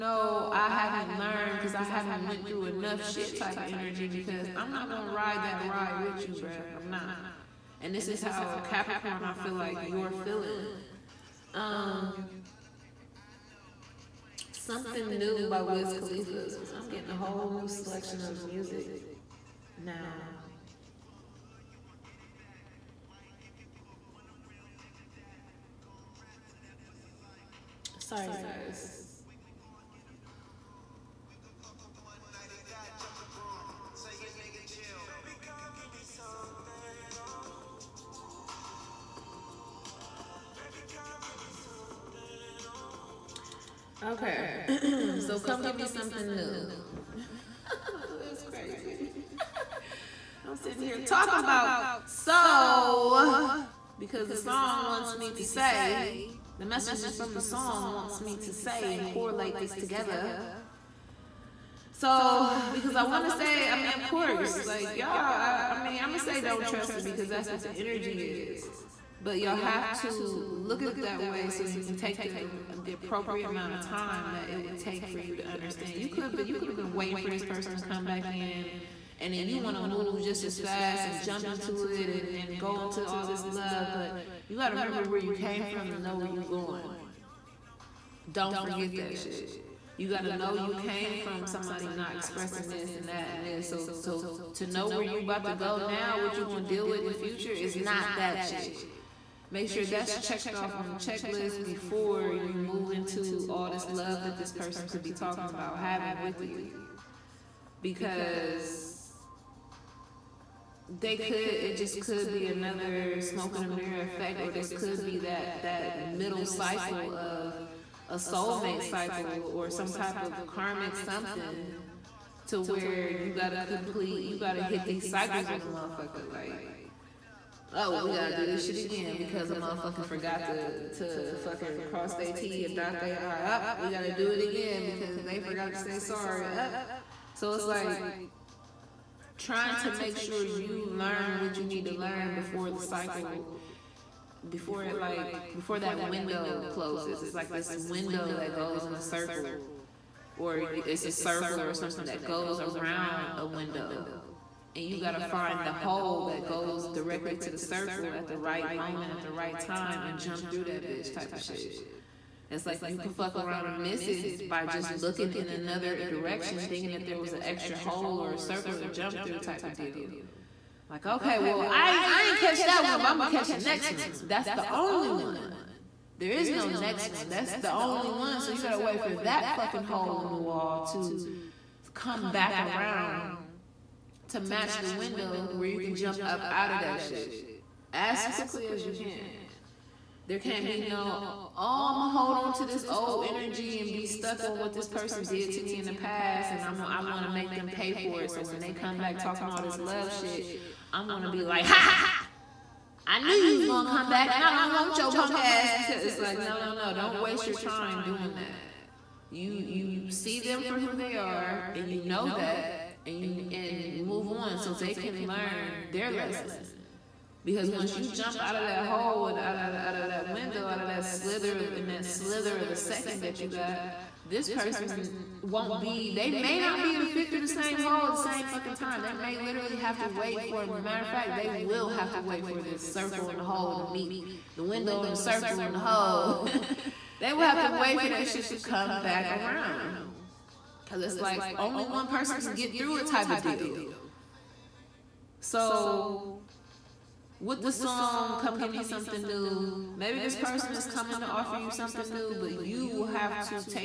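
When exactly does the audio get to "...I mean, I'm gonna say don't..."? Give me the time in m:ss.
1:05.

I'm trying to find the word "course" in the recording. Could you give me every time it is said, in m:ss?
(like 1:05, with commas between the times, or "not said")
1:04.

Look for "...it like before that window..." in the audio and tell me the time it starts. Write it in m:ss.
2:24.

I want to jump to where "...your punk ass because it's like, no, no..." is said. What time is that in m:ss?
3:24.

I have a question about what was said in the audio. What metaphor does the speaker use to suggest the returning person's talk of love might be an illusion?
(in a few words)
smoke in a mirror.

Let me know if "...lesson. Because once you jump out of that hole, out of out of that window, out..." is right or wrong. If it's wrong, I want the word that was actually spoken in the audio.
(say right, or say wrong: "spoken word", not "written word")
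right.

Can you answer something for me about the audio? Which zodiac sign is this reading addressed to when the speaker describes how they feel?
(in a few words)
Capricorn.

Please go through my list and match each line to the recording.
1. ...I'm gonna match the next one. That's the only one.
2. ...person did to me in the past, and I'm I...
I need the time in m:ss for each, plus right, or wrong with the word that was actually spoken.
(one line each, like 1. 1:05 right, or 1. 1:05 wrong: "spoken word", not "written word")
1. 2:53 wrong: "catch", not "match"
2. 3:14 right.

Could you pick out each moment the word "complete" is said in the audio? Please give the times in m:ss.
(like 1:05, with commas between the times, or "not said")
2:03.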